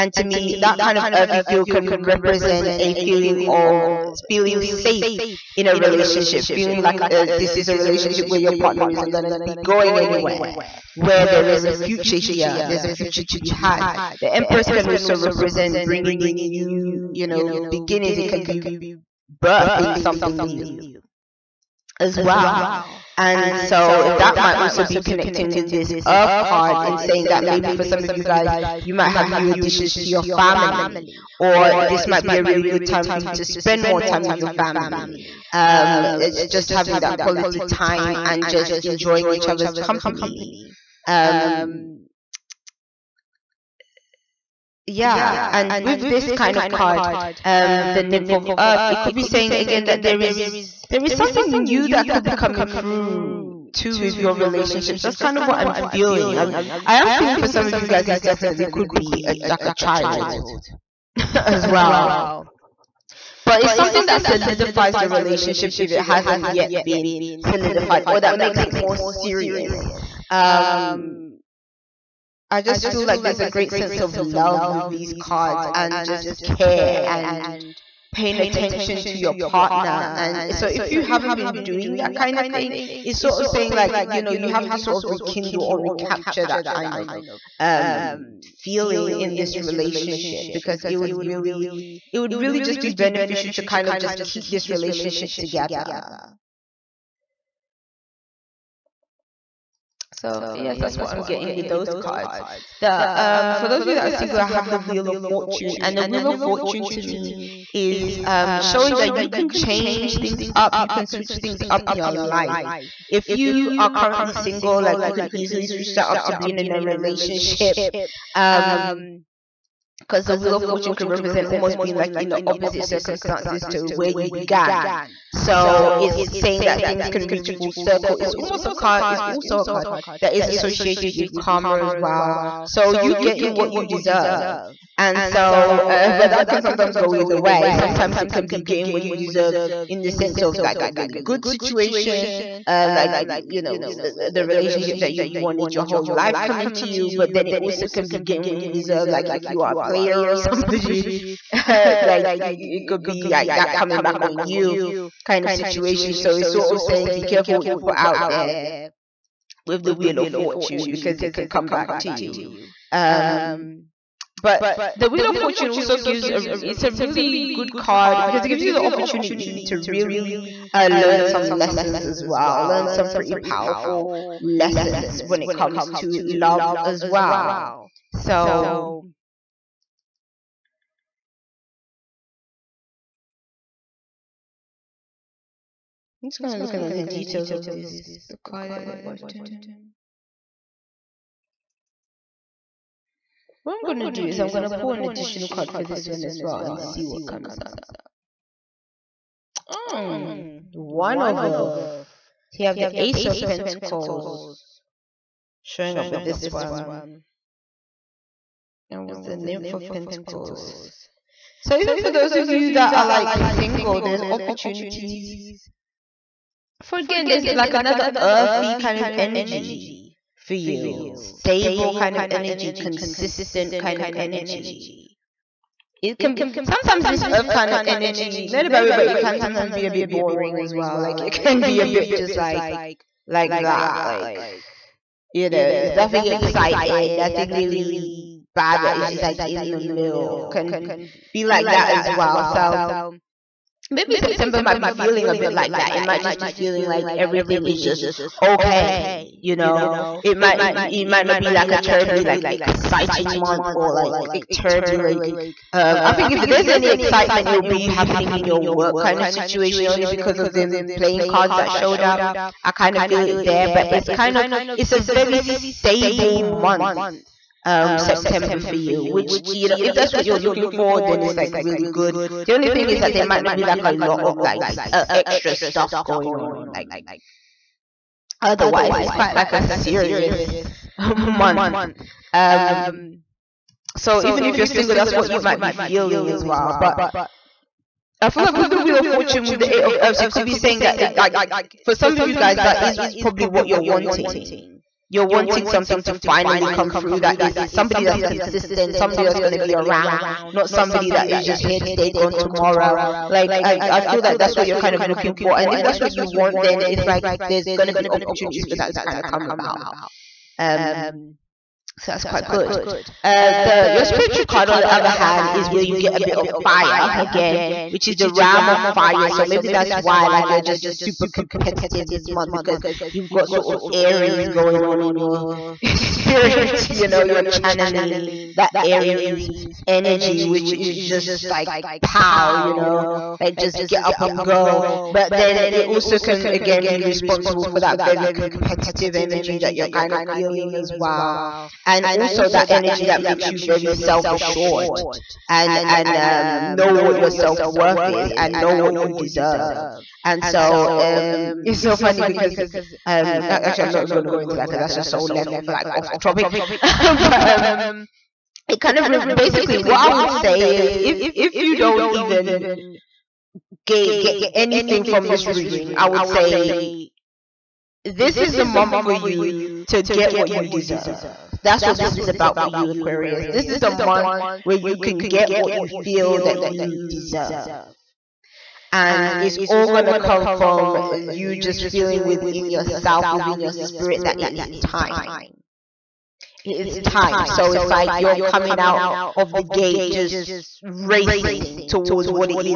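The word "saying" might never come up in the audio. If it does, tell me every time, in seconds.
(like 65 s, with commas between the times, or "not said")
26 s, 49 s, 83 s, 126 s, 156 s, 290 s.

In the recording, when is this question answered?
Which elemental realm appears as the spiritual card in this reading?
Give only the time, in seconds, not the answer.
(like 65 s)
318 s.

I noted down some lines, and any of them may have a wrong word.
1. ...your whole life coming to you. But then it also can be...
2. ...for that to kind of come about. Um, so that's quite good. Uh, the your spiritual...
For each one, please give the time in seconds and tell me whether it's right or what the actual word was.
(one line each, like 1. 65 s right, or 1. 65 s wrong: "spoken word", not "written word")
1. 145 s right
2. 308 s right.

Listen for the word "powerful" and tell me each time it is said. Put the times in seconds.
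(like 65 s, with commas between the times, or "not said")
173 s.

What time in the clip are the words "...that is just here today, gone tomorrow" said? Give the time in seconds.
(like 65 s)
301 s.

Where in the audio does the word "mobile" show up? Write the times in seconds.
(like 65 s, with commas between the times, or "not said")
not said.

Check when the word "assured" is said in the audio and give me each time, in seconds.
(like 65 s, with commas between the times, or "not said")
344 s.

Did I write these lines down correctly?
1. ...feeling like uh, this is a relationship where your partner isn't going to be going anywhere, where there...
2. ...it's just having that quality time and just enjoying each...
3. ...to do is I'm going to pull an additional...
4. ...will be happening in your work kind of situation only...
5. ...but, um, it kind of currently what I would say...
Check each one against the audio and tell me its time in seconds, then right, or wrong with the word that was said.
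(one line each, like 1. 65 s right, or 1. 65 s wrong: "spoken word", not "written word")
1. 6 s right
2. 36 s right
3. 193 s right
4. 257 s right
5. 356 s wrong: "basically", not "currently".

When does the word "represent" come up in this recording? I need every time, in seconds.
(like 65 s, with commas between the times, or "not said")
2 s, 15 s, 121 s.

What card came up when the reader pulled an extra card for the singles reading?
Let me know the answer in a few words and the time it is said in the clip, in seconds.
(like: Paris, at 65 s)
Ace of Pentacles, at 202 s.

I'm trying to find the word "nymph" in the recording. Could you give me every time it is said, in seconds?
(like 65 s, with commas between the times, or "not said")
48 s, 209 s.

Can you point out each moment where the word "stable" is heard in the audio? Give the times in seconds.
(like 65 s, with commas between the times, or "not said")
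221 s, 265 s.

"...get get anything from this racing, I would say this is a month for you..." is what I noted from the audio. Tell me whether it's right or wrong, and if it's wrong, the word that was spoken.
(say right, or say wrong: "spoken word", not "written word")
wrong: "reading", not "racing".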